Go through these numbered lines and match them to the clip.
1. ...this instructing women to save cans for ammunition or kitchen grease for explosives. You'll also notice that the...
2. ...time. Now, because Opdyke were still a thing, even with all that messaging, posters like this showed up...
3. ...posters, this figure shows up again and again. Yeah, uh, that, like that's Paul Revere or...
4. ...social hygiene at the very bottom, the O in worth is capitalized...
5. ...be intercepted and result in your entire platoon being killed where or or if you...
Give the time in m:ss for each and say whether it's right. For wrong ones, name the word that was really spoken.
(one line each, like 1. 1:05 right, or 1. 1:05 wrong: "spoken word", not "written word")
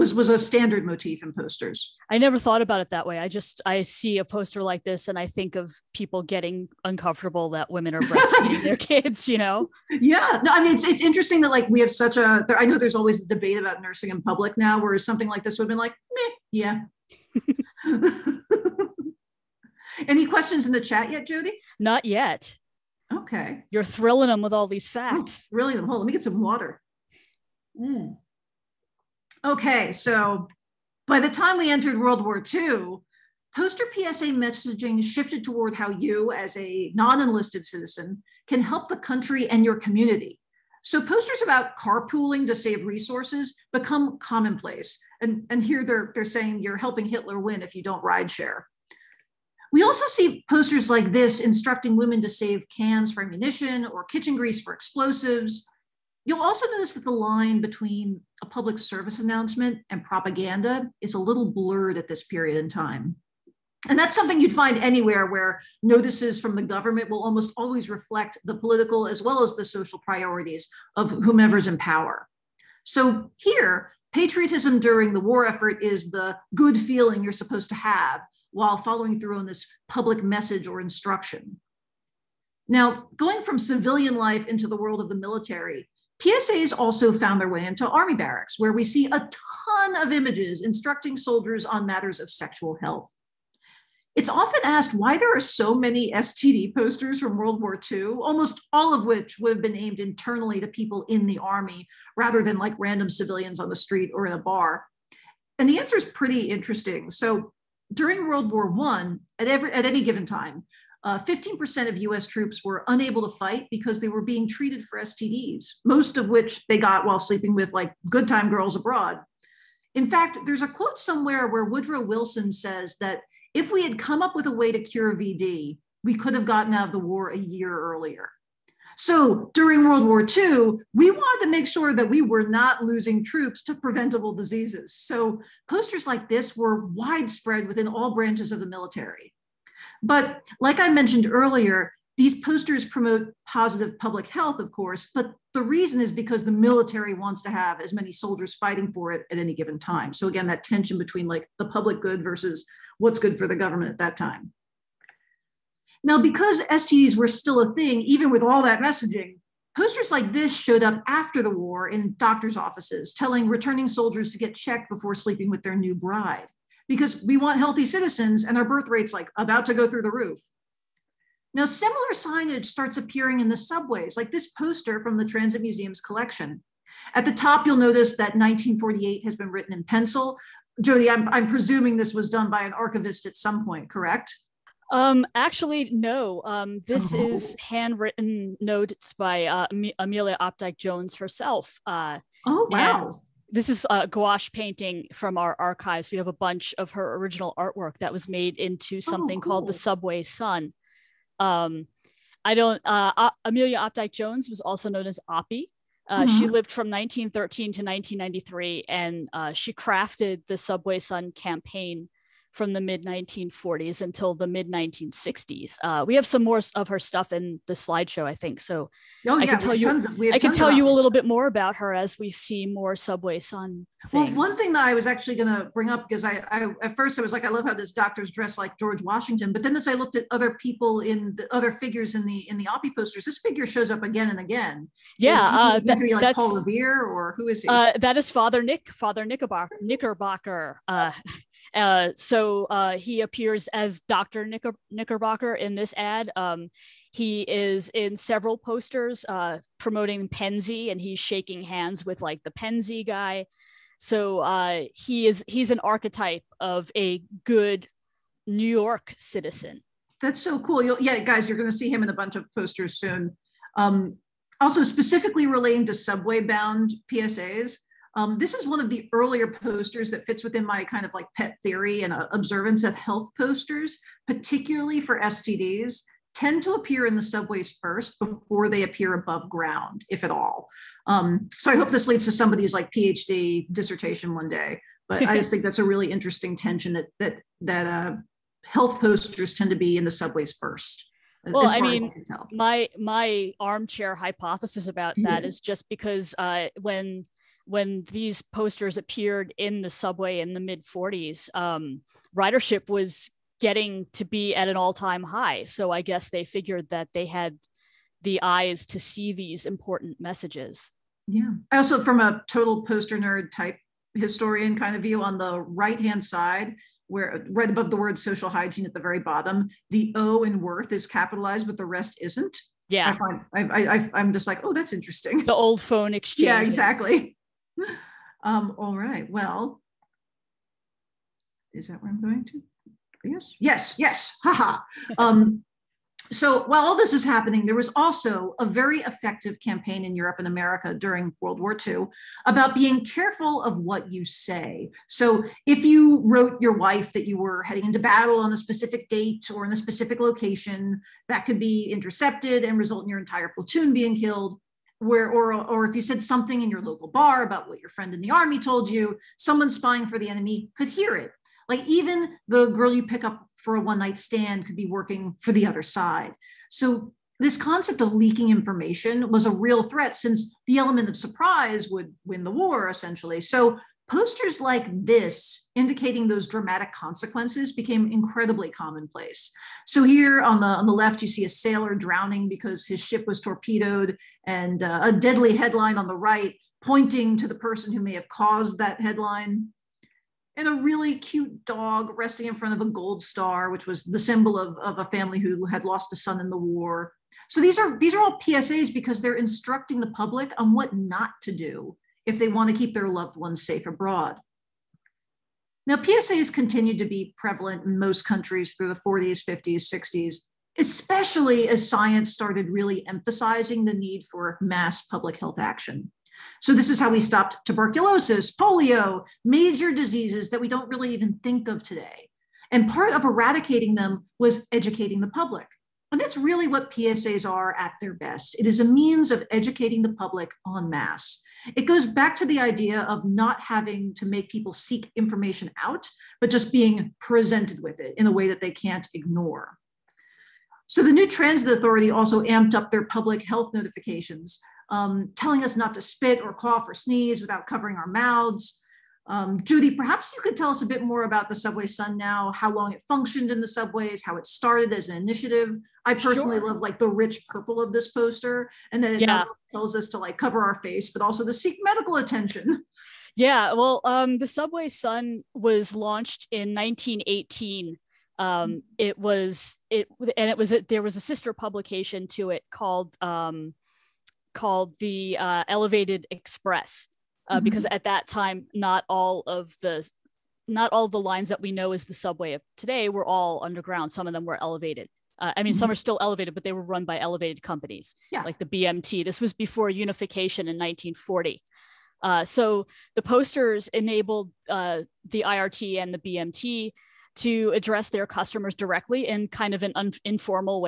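1. 0:51 right
2. 2:34 wrong: "STDs", not "Opdyke"
3. 3:52 right
4. 5:18 right
5. 5:51 right.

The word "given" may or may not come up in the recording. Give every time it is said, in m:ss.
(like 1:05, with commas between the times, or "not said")
1:50, 2:29.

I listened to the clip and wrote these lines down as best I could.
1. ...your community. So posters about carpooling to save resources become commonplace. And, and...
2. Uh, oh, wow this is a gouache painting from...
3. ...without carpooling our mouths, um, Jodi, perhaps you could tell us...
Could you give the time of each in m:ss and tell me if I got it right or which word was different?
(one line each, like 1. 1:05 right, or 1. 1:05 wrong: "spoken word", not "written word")
1. 0:39 right
2. 3:11 right
3. 7:27 wrong: "covering", not "carpooling".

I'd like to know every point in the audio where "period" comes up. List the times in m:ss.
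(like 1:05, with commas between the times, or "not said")
1:02.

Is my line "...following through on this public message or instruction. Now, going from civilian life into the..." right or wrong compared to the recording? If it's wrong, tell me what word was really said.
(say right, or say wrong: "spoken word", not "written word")
right.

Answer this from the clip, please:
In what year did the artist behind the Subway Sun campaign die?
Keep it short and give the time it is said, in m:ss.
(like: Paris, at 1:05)
1993, at 3:27.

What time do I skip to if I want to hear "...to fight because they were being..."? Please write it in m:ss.
1:53.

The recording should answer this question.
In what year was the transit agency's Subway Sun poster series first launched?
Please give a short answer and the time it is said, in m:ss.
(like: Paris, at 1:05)
1918, at 7:46.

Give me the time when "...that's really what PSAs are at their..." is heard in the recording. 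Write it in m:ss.
7:06.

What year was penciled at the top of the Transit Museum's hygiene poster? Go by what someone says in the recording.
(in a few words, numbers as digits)
1948.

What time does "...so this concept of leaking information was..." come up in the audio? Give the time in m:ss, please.
6:06.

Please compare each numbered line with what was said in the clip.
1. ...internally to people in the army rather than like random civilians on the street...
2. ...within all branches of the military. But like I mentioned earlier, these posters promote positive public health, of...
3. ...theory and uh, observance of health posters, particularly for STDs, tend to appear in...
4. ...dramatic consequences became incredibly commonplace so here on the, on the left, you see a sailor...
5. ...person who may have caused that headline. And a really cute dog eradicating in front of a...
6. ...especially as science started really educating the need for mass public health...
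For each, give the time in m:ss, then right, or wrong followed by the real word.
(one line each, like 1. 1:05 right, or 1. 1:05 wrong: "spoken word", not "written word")
1. 1:39 right
2. 2:17 right
3. 4:31 right
4. 6:16 right
5. 6:27 wrong: "resting", not "eradicating"
6. 6:50 wrong: "emphasizing", not "educating".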